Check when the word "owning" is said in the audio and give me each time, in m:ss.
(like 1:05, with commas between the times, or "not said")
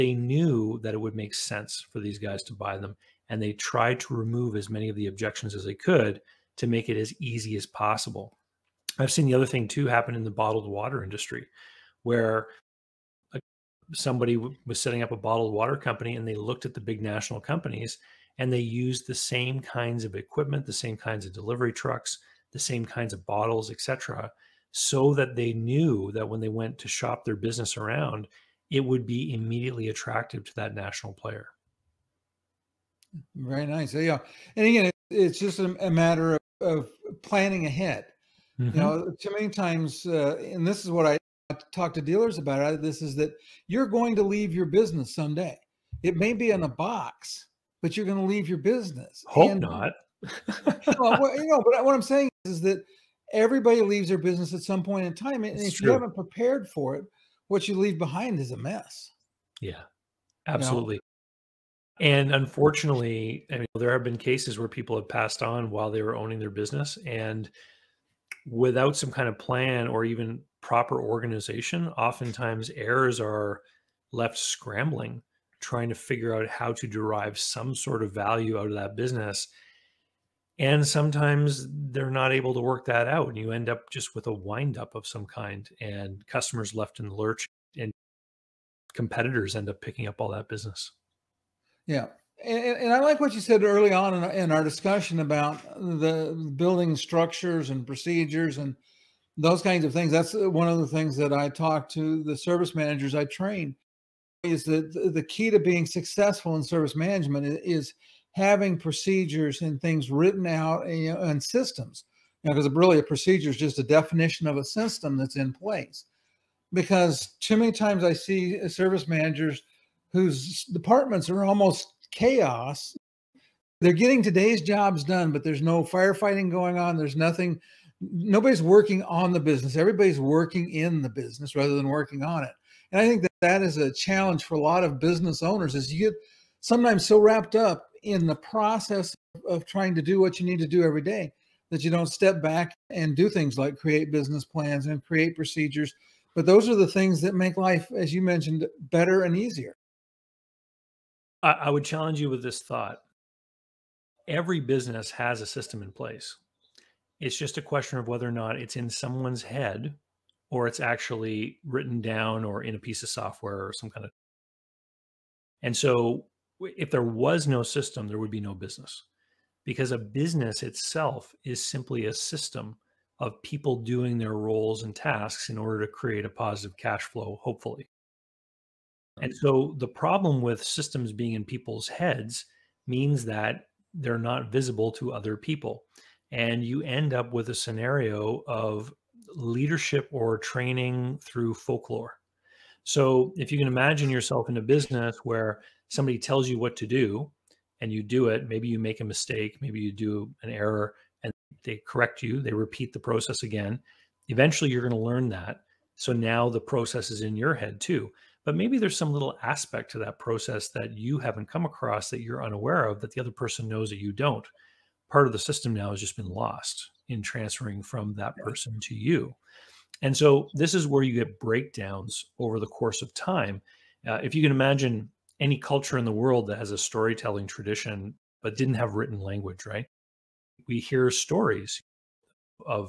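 1:06.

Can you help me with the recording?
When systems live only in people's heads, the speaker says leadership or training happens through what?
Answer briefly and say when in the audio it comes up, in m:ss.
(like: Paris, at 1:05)
folklore, at 3:11.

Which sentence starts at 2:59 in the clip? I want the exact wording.
And so the problem with systems being in people's heads means that they're not visible to other people.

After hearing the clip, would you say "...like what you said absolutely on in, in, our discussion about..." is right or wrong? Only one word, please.
wrong.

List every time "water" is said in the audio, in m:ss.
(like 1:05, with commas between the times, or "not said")
0:10, 0:15.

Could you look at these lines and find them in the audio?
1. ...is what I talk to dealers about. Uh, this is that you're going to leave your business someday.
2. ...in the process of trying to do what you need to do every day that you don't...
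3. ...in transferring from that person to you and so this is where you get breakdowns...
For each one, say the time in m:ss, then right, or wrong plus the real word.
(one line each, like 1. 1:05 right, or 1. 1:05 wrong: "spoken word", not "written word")
1. 0:40 right
2. 2:18 right
3. 3:37 right.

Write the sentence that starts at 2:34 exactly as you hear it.
Every business has a system in place.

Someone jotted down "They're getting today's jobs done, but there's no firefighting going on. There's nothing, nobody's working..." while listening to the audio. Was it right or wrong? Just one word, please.
right.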